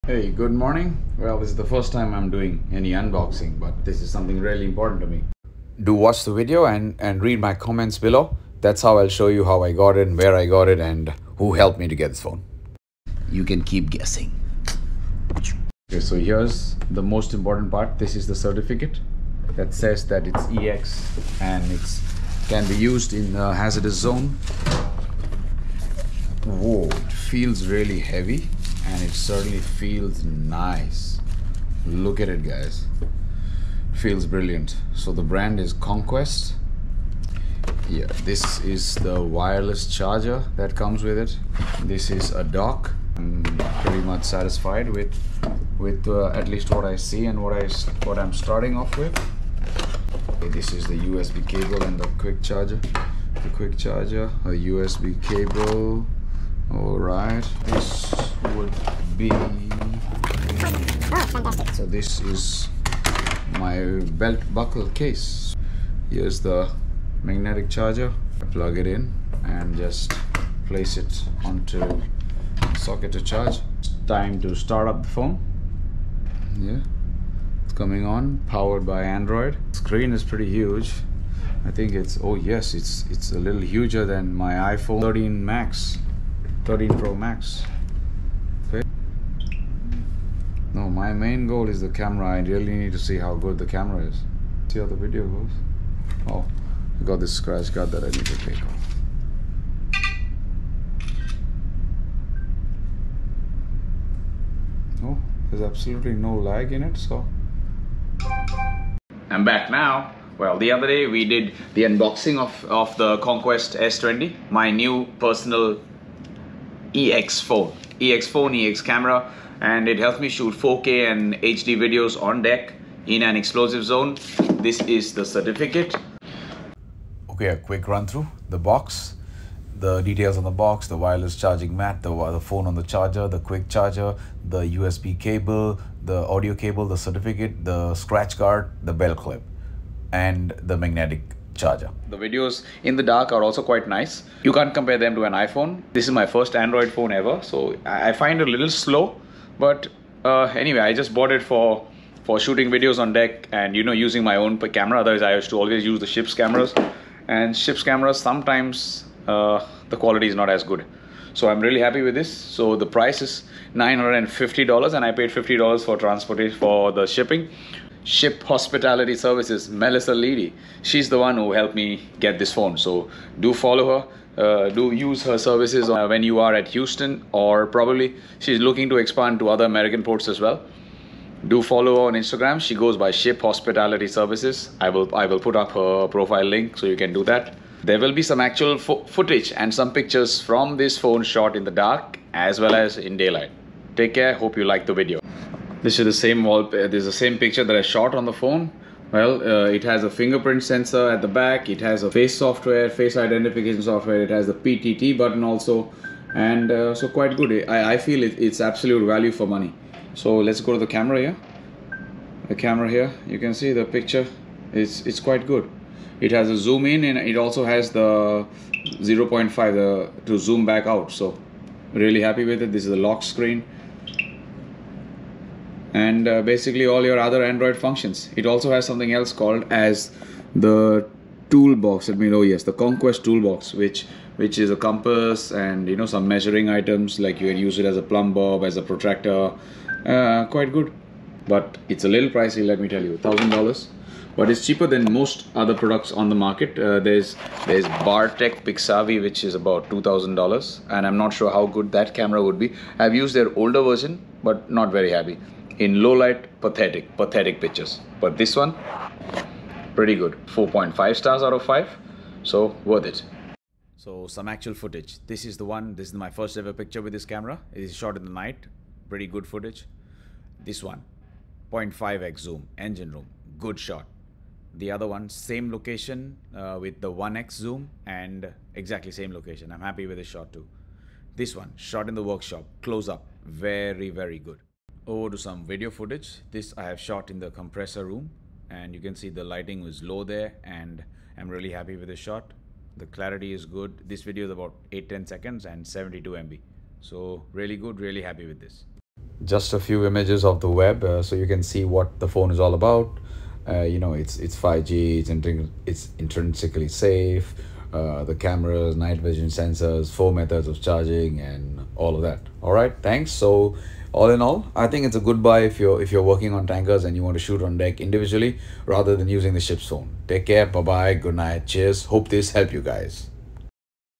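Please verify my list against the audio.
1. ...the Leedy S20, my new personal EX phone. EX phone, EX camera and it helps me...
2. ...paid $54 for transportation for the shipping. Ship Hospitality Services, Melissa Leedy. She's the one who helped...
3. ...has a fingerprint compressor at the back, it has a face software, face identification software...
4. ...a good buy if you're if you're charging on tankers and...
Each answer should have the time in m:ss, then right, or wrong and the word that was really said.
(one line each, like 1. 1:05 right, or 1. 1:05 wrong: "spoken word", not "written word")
1. 1:52 wrong: "Conquest", not "Leedy"
2. 2:45 wrong: "50", not "54"
3. 3:19 wrong: "sensor", not "compressor"
4. 5:15 wrong: "working", not "charging".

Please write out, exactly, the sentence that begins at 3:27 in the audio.
I, I feel it, it's absolute value for money.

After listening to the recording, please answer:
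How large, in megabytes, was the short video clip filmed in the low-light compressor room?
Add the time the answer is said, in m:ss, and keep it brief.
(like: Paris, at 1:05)
72 MB, at 4:55.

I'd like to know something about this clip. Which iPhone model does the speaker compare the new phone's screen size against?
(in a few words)
iPhone 13 Pro Max.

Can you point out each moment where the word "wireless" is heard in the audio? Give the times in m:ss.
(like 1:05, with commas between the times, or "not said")
0:39, 2:10.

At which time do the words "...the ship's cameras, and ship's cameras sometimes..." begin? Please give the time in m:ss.
2:36.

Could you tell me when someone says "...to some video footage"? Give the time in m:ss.
4:45.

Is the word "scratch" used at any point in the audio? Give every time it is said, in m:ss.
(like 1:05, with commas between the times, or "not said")
1:37, 2:17.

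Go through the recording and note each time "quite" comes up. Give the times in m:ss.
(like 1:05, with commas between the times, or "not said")
2:23, 3:27, 3:35, 4:00.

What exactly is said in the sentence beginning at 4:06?
Uh, there's there's Bartec Pixavi, which is about two thousand dollars, and I'm not sure how good that camera would be.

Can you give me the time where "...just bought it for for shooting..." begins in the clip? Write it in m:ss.
2:30.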